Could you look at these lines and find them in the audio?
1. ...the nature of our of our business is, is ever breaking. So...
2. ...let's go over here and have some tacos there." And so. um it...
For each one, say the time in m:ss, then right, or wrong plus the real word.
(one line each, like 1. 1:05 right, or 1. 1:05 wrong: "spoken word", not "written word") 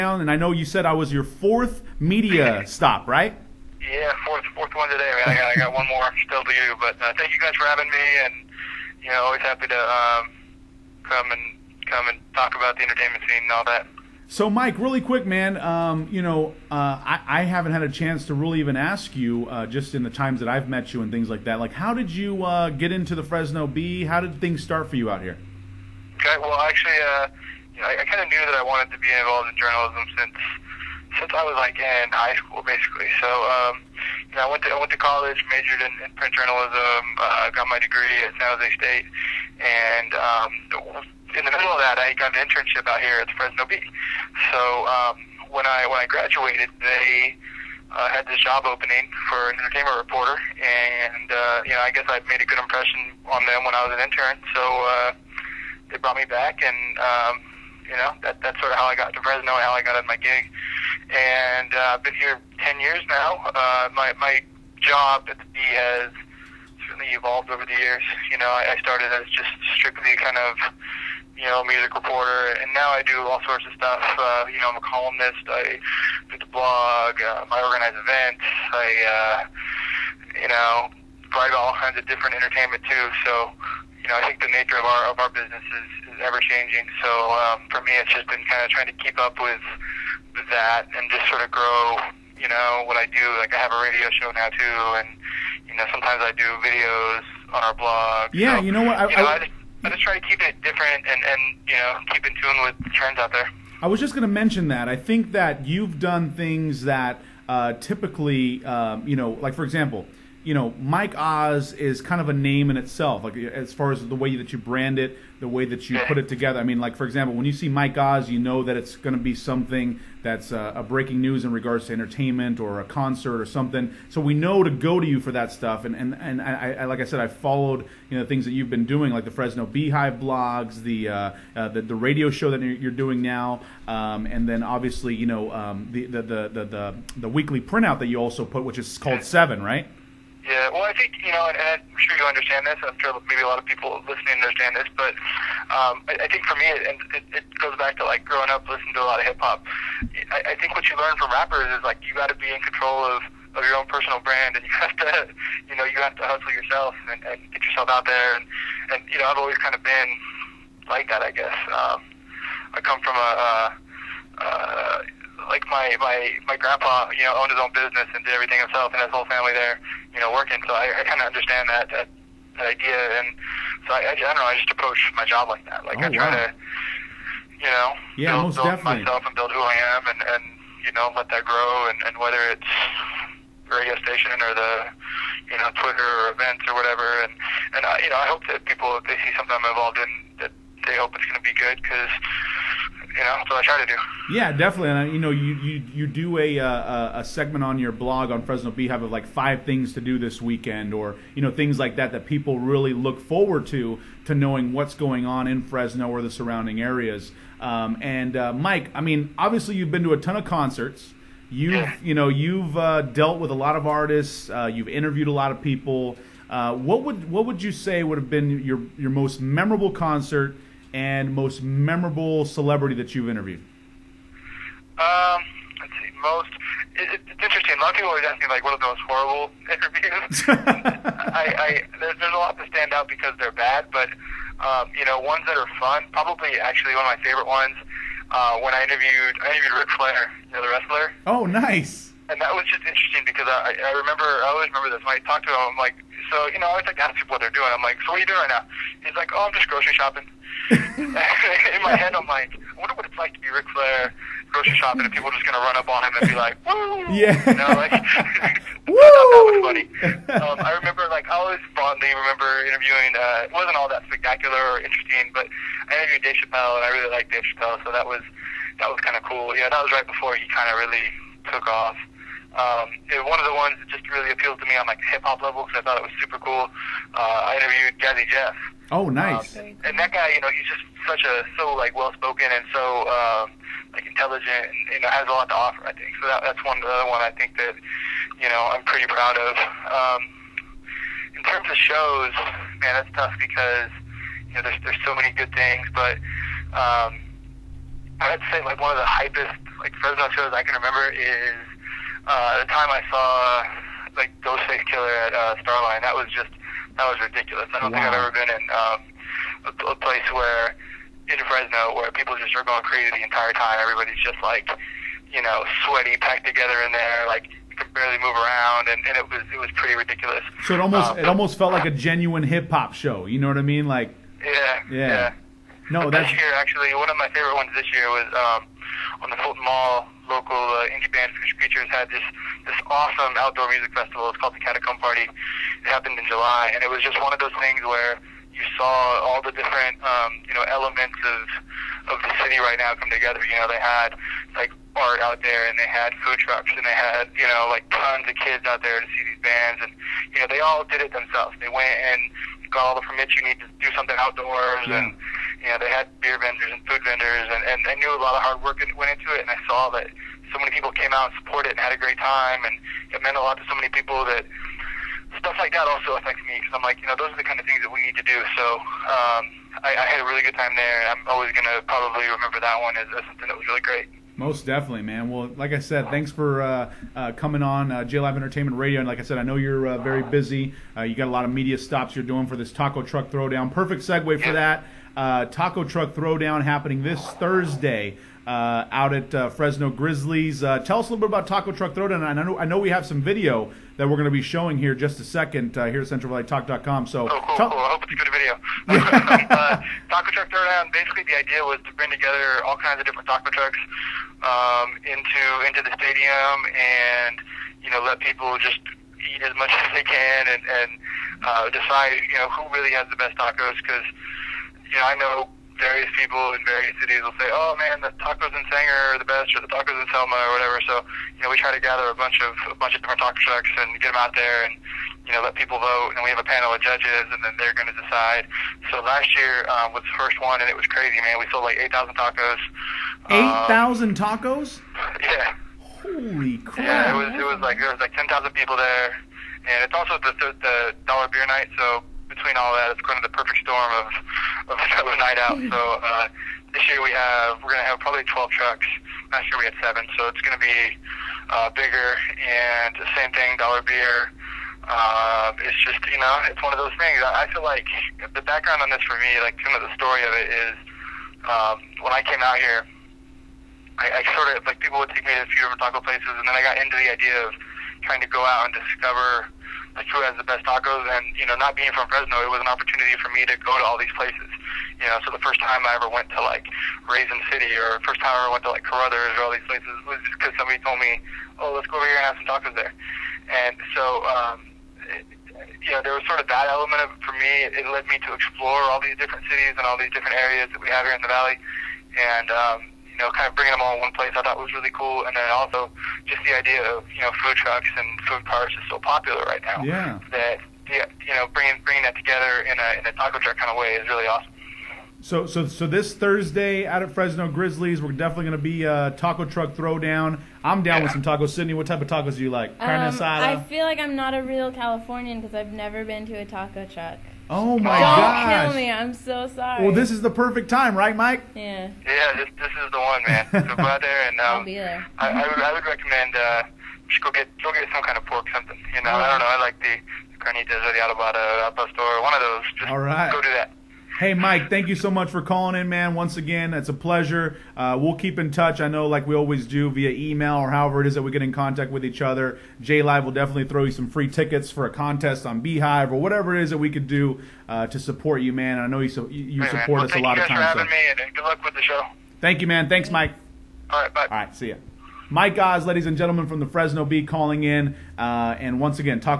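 1. 1:24 wrong: "changing", not "breaking"
2. 8:01 right.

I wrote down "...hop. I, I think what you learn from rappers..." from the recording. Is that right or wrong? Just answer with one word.
right.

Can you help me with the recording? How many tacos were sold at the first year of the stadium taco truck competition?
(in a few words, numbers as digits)
8000.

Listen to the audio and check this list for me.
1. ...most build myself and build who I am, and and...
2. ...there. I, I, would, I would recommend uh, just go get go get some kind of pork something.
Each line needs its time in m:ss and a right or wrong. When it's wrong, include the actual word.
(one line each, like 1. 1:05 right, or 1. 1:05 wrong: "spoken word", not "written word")
1. 2:58 right
2. 8:44 right.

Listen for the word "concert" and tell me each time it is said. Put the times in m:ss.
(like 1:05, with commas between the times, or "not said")
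2:02, 3:30, 3:39.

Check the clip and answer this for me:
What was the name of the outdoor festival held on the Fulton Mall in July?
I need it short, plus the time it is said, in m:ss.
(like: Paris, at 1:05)
Catacomb Party, at 5:34.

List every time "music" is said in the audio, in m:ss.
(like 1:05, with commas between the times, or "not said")
1:11, 5:33.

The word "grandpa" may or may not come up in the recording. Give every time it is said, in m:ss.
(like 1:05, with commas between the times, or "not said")
2:46.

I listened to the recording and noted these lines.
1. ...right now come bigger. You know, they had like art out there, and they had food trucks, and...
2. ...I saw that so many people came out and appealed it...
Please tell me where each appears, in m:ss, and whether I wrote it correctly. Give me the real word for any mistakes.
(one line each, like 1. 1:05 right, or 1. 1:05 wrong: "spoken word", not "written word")
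1. 5:42 wrong: "together", not "bigger"
2. 5:59 wrong: "supported", not "appealed".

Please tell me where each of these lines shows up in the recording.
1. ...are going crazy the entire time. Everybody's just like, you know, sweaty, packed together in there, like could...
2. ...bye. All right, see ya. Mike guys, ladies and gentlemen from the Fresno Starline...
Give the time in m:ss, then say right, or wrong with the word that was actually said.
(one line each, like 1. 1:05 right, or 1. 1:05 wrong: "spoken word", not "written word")
1. 5:12 right
2. 9:14 wrong: "Bee", not "Starline".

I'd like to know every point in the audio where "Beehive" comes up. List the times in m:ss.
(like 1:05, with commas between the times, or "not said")
2:09, 3:18, 9:05.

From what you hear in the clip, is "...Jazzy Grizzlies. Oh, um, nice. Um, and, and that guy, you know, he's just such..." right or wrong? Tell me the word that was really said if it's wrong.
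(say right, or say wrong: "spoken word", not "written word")
wrong: "Jeff", not "Grizzlies".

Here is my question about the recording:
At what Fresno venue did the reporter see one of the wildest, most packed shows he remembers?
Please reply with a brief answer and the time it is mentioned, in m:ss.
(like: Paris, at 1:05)
Starline, at 5:05.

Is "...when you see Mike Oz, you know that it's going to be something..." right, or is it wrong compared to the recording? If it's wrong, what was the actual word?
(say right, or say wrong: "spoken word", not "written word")
right.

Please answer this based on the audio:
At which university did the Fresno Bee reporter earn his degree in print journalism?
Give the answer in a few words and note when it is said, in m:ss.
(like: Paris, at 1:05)
San Jose State, at 0:38.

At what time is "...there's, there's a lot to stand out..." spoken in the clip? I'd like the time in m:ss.
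3:51.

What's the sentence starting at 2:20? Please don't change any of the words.
Yeah, well, I think you know, and, I'm sure you understand this.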